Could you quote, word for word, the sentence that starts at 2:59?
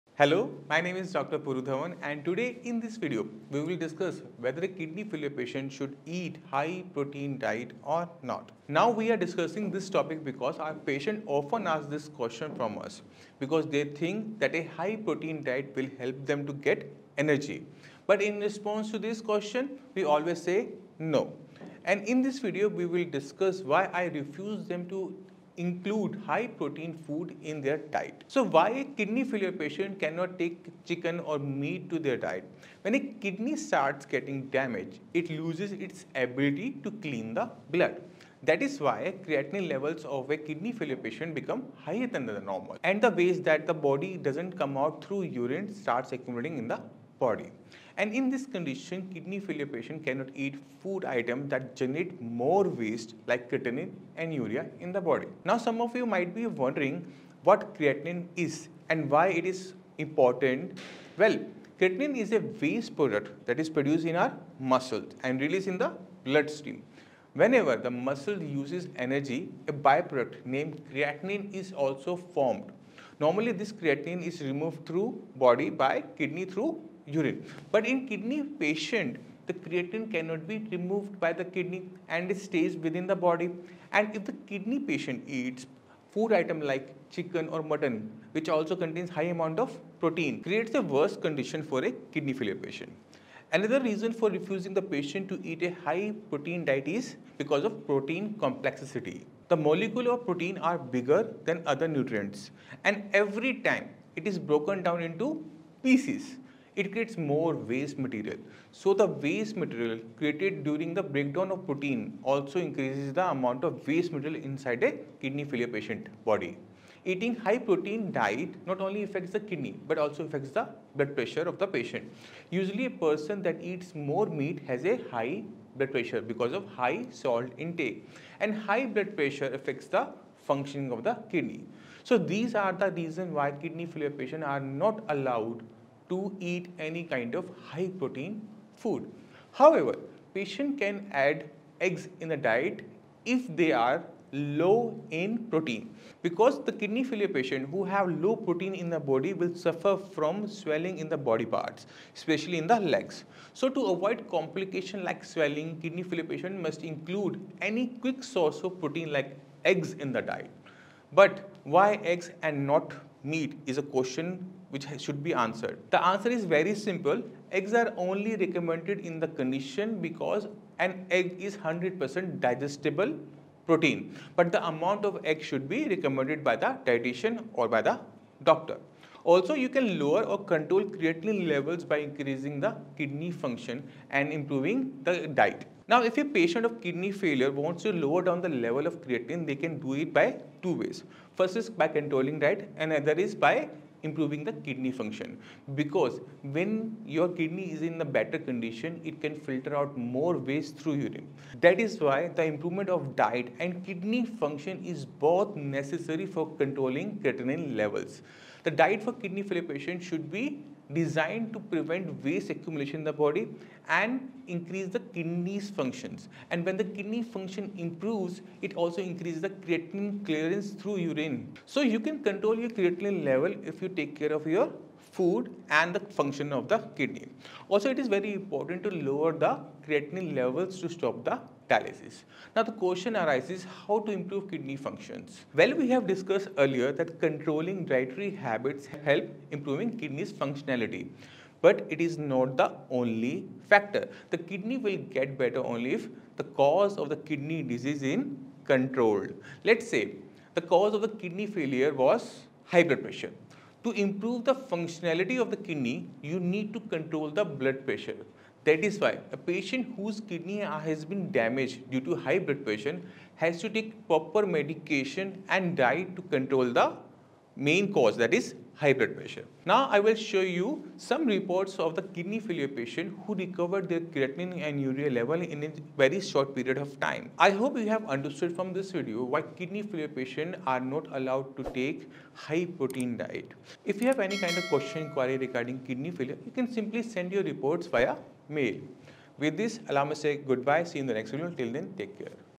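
Also, you can lower or control creatinine levels by increasing the kidney function and improving the diet.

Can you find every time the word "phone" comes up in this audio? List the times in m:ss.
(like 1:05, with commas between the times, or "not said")
not said.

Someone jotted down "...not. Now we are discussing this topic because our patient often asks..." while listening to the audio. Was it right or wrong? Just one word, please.
right.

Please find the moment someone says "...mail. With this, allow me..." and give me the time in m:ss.
4:48.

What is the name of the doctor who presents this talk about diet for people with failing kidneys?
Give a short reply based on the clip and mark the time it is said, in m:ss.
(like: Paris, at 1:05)
Puru Dhawan, at 0:01.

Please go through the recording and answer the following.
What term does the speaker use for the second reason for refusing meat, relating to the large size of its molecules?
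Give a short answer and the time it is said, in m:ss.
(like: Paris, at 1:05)
protein complexity, at 1:37.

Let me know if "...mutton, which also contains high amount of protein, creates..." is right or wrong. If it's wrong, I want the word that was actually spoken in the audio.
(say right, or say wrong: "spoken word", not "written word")
right.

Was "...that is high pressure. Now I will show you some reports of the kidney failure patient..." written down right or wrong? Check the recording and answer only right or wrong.
right.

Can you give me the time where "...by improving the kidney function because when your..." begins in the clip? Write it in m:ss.
3:13.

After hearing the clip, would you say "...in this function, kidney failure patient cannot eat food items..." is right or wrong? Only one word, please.
wrong.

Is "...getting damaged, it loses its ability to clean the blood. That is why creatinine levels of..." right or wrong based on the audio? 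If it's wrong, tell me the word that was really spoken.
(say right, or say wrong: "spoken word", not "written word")
right.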